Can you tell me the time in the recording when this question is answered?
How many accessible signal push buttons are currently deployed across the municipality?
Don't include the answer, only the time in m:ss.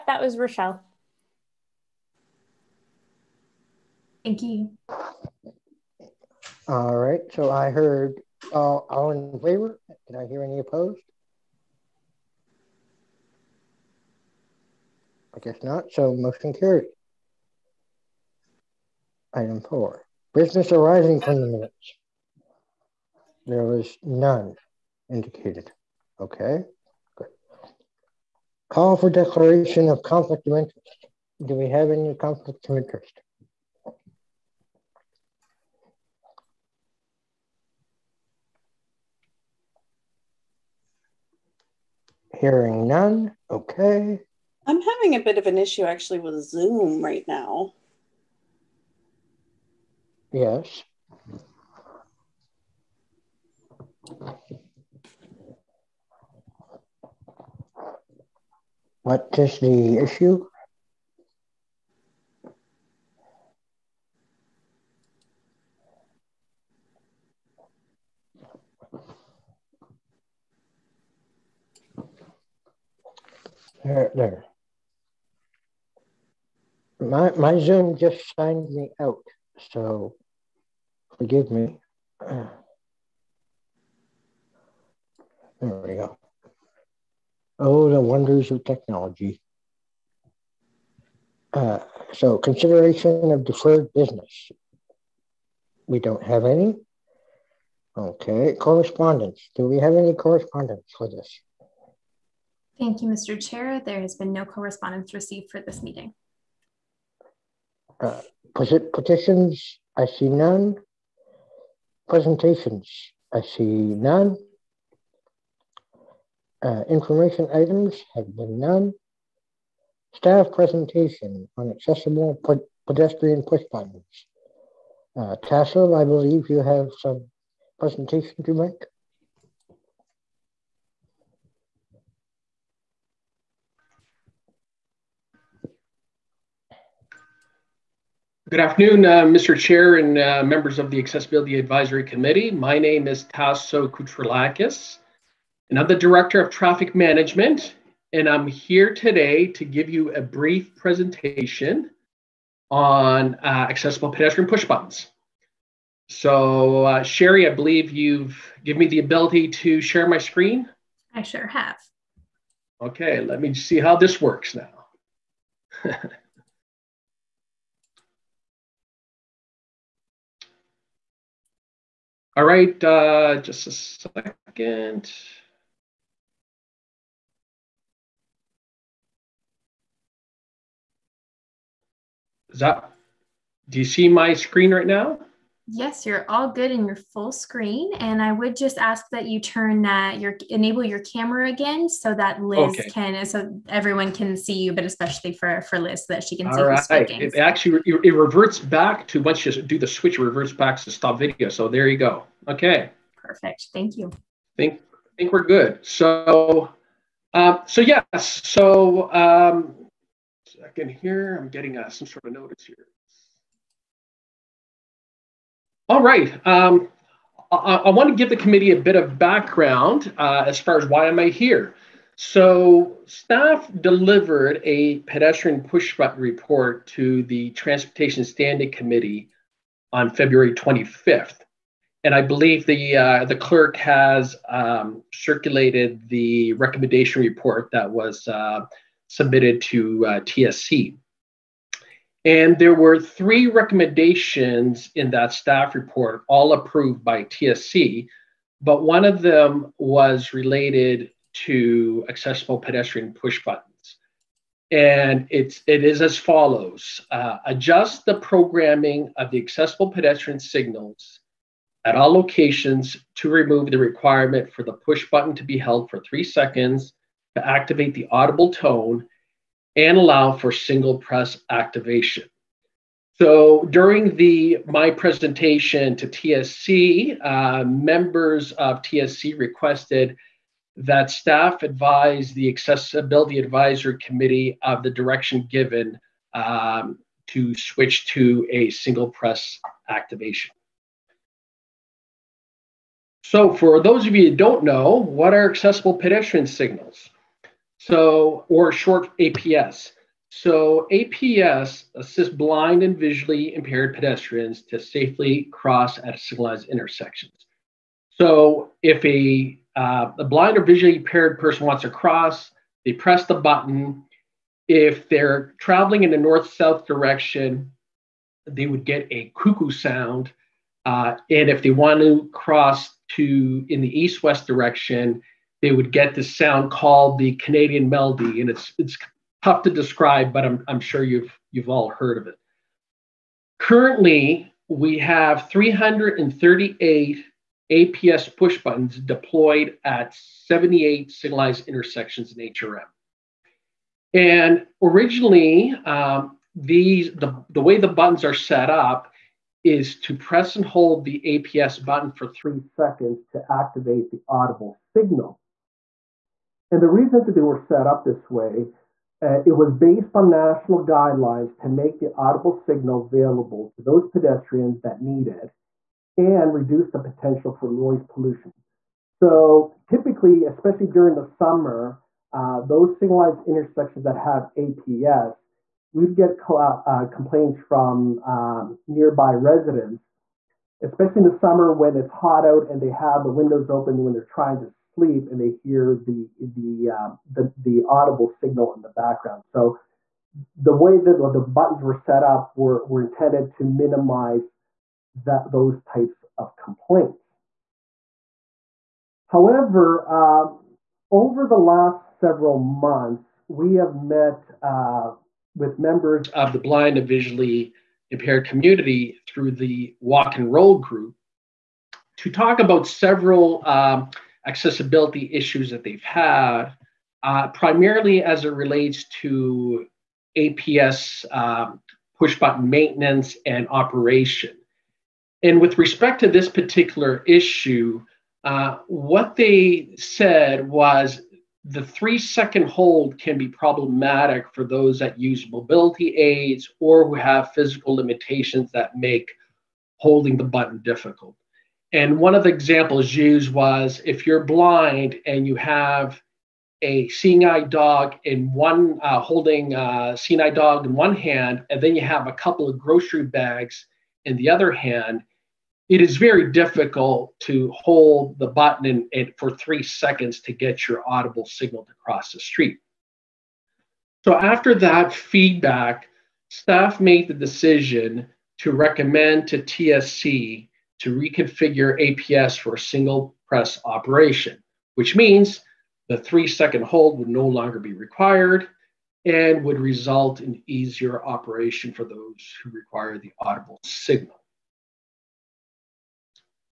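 5:35.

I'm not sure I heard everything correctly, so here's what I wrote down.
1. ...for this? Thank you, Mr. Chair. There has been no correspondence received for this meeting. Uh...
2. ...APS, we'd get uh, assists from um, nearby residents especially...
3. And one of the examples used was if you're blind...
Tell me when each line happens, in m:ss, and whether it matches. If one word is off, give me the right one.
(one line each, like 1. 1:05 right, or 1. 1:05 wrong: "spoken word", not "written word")
1. 1:40 right
2. 6:14 wrong: "complaints", not "assists"
3. 7:21 right.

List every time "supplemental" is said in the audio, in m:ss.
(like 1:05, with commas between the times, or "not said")
not said.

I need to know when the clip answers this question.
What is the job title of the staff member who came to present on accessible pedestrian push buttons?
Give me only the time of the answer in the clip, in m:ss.
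2:25.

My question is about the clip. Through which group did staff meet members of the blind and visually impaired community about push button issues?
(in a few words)
walk and roll group.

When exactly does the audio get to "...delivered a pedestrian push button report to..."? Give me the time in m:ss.
3:43.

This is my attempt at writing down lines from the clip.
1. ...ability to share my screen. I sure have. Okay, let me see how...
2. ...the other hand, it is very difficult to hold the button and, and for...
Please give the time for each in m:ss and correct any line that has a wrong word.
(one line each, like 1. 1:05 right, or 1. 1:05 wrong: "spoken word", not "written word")
1. 2:38 right
2. 7:34 right.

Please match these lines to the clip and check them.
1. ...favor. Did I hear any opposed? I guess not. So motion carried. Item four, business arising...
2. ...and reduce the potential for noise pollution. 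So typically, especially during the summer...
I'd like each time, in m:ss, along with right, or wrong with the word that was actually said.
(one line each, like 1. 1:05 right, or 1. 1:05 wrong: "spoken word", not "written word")
1. 0:09 right
2. 6:06 right.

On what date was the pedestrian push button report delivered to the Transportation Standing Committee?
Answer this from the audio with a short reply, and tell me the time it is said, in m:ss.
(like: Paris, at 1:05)
February 25th, at 3:50.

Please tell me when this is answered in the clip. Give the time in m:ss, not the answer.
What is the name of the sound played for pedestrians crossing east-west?
5:27.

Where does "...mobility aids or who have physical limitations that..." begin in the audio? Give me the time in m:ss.
7:15.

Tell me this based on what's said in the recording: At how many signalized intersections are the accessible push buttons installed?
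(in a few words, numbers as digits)
78.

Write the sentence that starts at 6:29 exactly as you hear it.
So the way that the buttons were set up were, were intended to minimize that those types of complaints.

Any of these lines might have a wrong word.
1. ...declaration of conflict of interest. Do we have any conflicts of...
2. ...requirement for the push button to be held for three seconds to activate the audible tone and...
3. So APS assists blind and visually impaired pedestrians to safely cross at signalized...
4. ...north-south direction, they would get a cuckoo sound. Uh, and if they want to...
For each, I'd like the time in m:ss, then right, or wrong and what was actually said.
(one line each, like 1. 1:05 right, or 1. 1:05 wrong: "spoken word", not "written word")
1. 0:29 right
2. 4:23 right
3. 5:00 right
4. 5:16 right.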